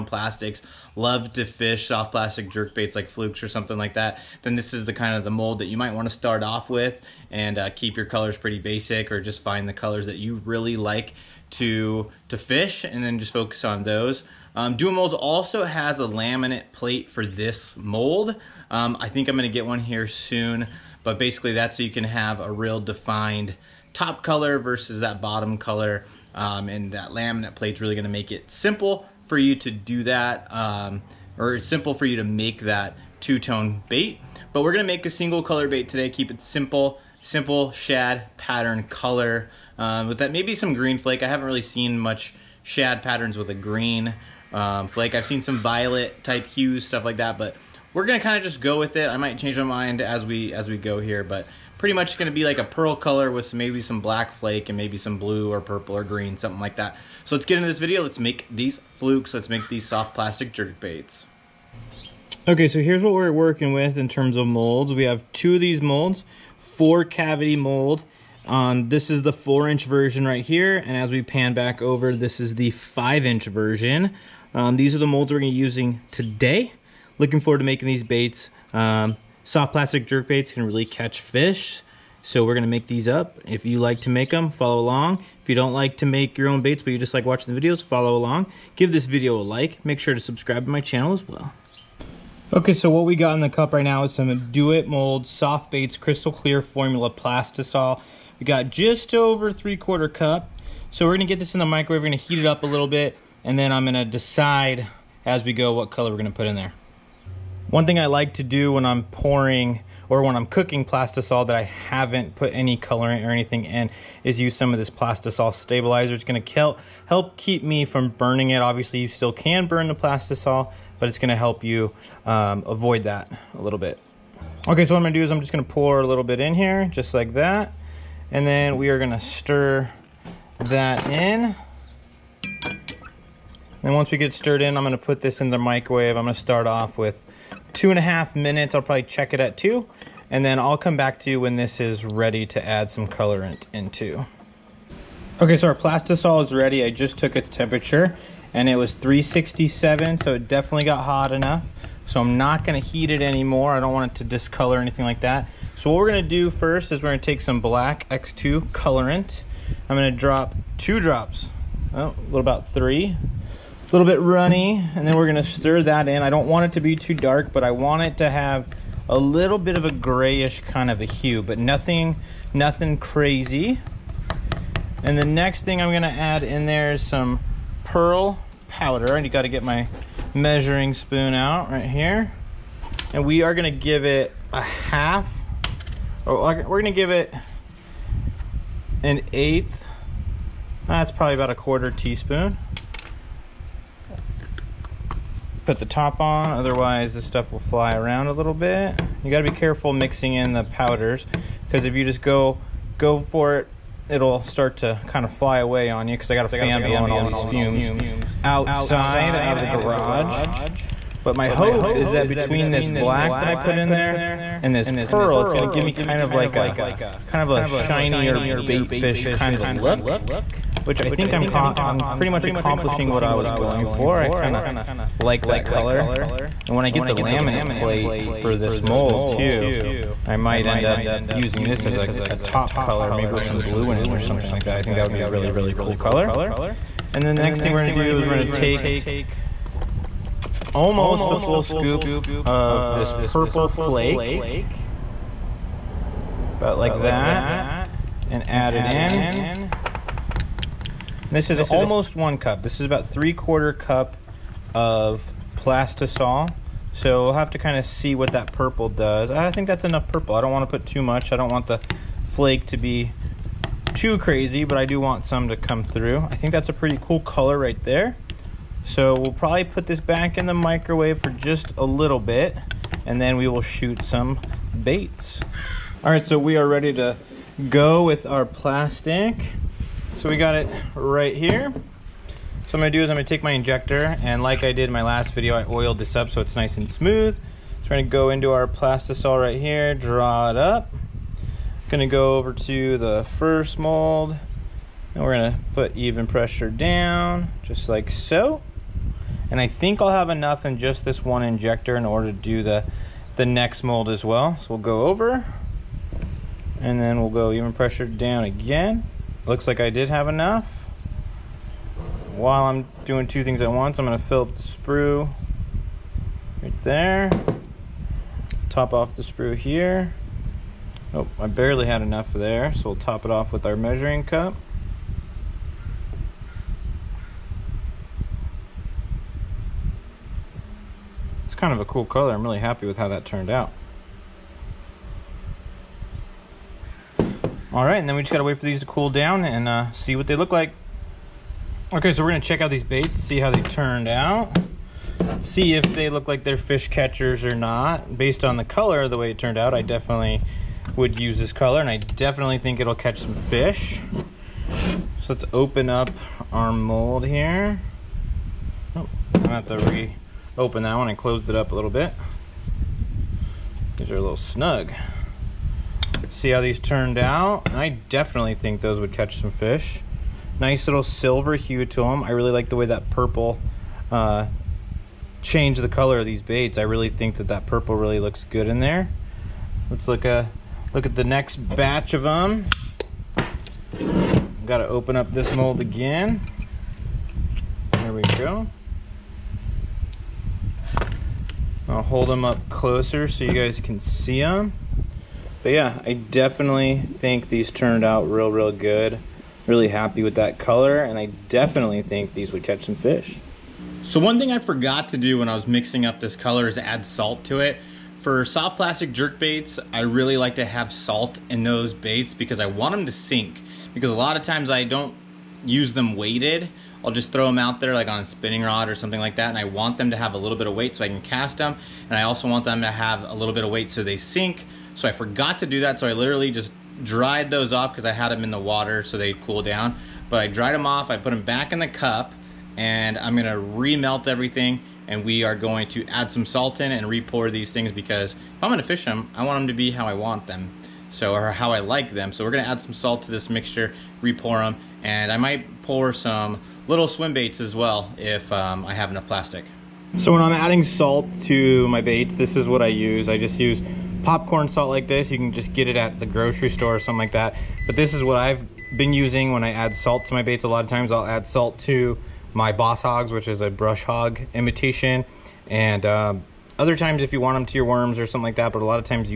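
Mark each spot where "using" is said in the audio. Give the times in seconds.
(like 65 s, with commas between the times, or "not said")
75 s, 231 s, 459 s.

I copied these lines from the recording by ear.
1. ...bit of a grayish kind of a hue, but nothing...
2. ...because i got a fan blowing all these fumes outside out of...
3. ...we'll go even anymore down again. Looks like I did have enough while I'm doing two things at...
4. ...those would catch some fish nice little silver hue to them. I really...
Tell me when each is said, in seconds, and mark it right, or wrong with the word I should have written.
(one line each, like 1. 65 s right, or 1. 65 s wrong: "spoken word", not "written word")
1. 169 s right
2. 206 s right
3. 307 s wrong: "pressure", not "anymore"
4. 368 s right.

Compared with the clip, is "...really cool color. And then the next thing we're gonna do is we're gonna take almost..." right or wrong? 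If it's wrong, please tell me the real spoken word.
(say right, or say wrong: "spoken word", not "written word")
right.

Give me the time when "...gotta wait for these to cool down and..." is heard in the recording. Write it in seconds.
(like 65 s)
338 s.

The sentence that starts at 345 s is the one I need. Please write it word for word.
See if they look like they're fish catchers or not.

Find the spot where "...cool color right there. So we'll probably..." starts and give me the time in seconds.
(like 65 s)
267 s.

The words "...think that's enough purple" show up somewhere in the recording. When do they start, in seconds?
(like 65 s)
259 s.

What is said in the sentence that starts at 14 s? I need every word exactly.
Um, Do It Molds also has a laminate plate for this mold.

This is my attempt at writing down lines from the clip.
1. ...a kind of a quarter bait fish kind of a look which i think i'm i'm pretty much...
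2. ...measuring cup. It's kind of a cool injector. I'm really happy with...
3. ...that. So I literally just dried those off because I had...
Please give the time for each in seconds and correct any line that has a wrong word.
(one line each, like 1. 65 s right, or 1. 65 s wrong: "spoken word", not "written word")
1. 216 s wrong: "shinier", not "quarter"
2. 323 s wrong: "color", not "injector"
3. 425 s right.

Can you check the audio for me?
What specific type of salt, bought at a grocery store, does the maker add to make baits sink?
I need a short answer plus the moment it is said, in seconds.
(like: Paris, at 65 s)
popcorn salt, at 454 s.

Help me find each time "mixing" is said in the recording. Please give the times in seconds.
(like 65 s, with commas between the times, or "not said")
199 s, 405 s.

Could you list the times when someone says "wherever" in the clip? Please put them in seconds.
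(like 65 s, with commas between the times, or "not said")
not said.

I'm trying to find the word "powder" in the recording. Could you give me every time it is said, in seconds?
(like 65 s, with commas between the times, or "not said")
178 s, 200 s.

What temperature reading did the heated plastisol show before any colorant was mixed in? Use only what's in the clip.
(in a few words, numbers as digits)
367.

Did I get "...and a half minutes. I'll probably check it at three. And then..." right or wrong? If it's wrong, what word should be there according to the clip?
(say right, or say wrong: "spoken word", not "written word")
wrong: "two", not "three".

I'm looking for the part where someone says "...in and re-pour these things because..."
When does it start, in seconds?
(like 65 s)
436 s.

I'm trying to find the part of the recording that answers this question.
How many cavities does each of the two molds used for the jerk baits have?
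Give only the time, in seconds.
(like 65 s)
66 s.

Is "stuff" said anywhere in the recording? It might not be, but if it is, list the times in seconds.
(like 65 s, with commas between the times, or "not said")
46 s, 197 s.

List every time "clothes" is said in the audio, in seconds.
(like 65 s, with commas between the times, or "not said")
not said.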